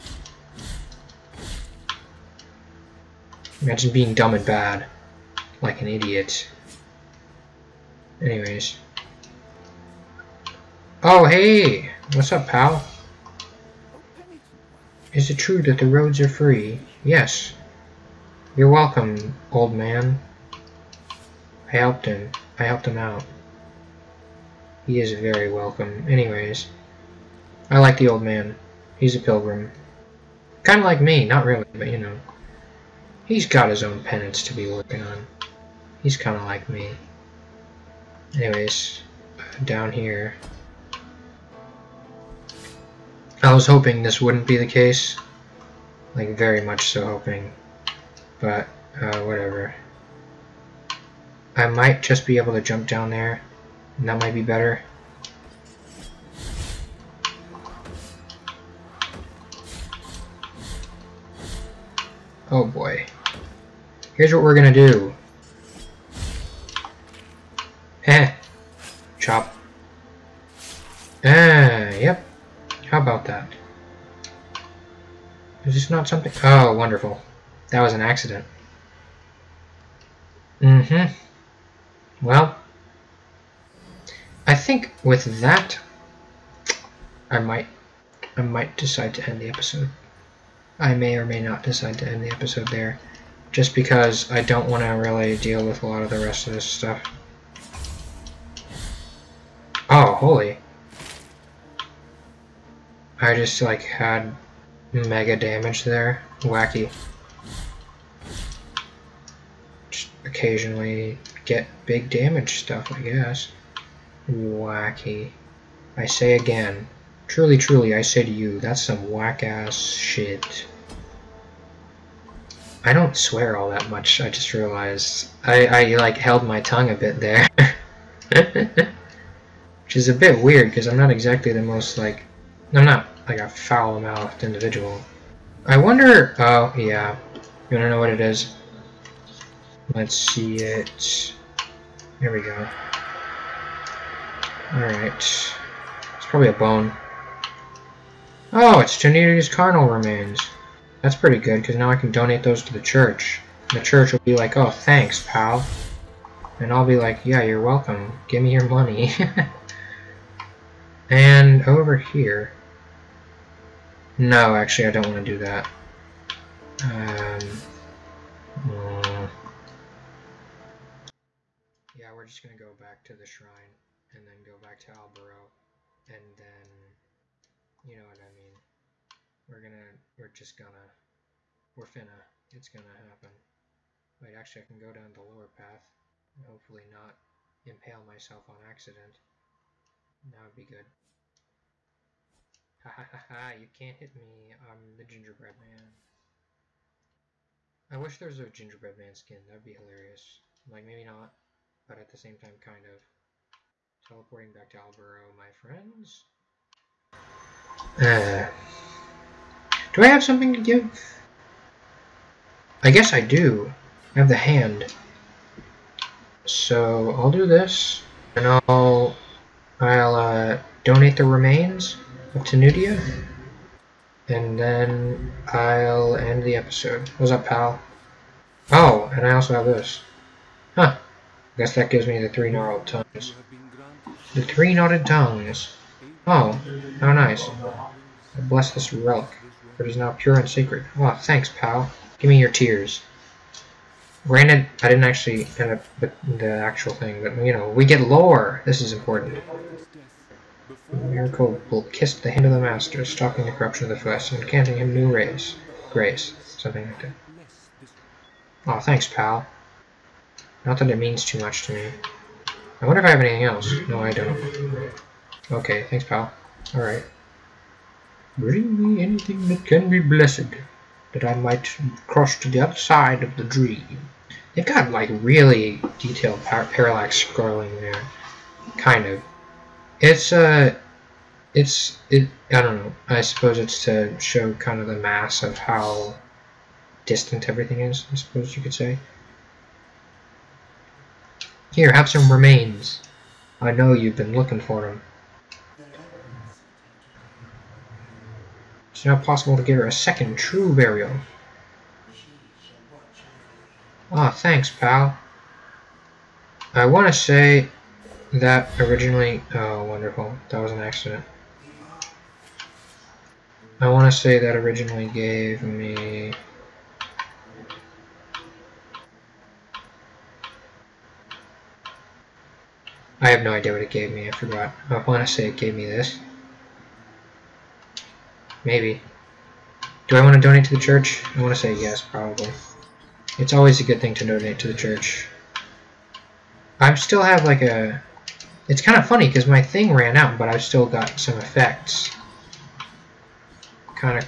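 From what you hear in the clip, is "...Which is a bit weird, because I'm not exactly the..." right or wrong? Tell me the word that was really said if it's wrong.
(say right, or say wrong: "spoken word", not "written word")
right.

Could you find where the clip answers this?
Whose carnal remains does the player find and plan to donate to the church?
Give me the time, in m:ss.
2:29.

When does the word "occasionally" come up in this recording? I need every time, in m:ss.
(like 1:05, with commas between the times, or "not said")
1:50.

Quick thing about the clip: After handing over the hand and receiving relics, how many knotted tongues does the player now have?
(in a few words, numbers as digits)
3.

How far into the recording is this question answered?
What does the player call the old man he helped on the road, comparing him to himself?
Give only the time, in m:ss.
0:28.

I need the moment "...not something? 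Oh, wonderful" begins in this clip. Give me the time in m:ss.
1:15.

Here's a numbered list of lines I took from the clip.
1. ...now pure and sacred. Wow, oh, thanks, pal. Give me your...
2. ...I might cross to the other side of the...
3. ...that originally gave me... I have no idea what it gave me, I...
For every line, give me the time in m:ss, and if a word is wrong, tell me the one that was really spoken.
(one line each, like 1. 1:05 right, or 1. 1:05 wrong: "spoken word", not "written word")
1. 3:59 right
2. 4:31 right
3. 5:14 right.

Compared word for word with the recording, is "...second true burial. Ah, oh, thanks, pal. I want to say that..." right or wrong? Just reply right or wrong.
right.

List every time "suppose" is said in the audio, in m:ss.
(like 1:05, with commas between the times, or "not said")
4:43, 4:48.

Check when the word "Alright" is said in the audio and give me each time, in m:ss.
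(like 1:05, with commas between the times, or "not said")
2:24, 4:26.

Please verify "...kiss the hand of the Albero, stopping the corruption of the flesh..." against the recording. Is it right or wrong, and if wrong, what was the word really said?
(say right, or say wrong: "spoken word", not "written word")
wrong: "Master", not "Albero".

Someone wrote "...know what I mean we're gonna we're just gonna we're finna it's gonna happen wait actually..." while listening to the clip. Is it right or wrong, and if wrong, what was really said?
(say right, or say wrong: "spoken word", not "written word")
right.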